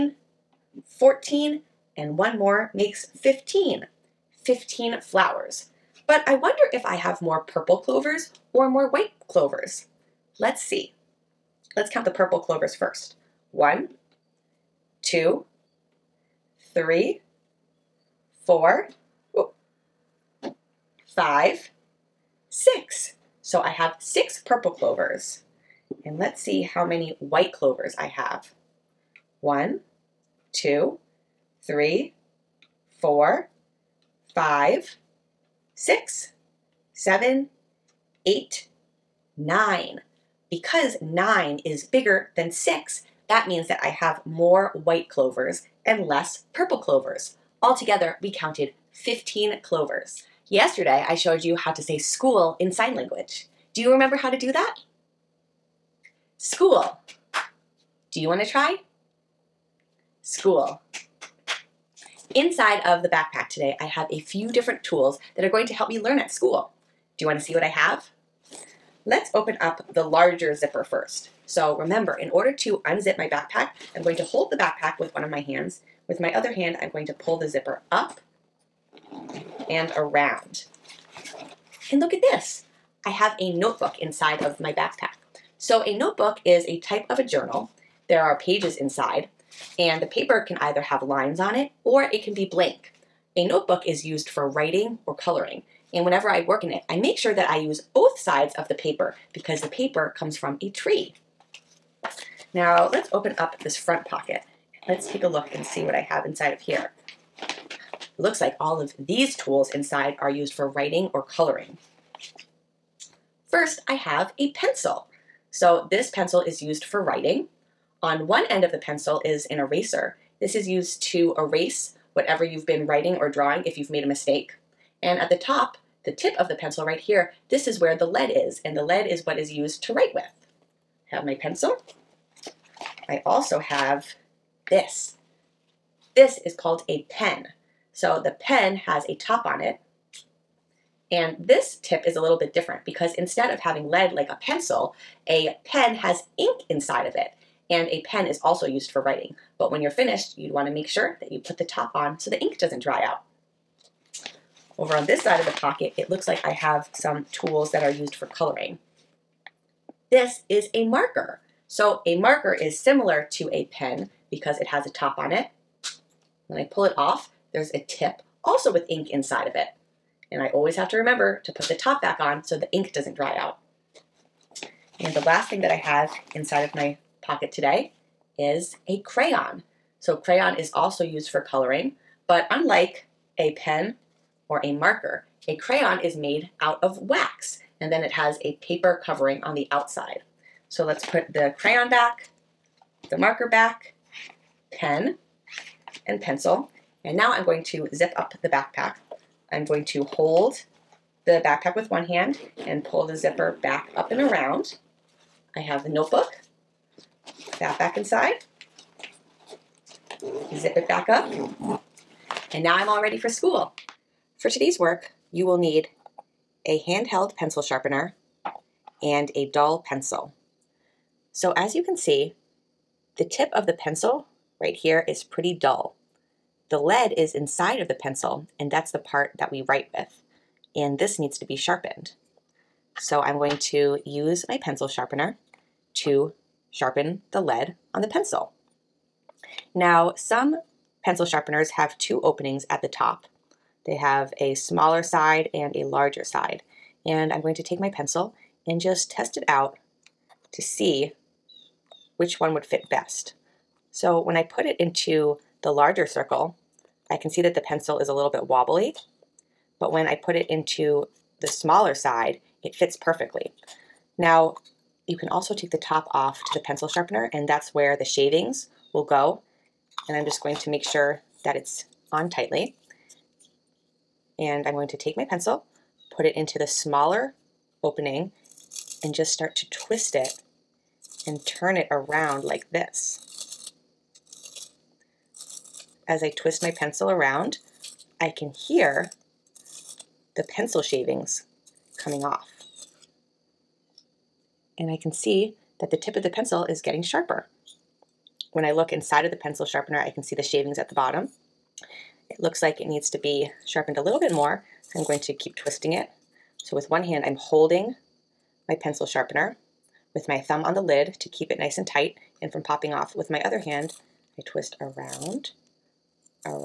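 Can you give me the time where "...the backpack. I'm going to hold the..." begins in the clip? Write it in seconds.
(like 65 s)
198 s.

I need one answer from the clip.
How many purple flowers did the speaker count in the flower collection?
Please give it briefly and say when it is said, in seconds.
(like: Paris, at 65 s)
6, at 23 s.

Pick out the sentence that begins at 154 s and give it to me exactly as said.
Over on this side of the pocket, it looks like I have some tools that are used for coloring.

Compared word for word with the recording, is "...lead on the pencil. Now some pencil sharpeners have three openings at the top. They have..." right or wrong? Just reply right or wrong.
wrong.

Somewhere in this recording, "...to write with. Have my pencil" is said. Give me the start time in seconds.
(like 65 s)
129 s.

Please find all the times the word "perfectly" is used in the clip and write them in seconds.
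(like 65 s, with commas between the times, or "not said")
262 s.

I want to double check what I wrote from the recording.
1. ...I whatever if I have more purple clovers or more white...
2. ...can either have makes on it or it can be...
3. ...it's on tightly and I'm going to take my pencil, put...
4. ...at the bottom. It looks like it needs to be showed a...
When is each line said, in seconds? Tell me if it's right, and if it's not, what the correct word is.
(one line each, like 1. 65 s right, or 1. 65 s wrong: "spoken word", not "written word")
1. 6 s wrong: "wonder", not "whatever"
2. 90 s wrong: "lines", not "makes"
3. 271 s right
4. 300 s wrong: "sharpened", not "showed".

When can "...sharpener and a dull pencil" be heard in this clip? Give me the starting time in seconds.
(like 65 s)
217 s.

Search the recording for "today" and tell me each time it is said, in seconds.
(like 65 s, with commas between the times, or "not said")
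63 s, 177 s, 214 s.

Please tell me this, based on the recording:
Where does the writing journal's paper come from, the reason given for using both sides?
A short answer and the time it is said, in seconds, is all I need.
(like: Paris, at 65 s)
a tree, at 99 s.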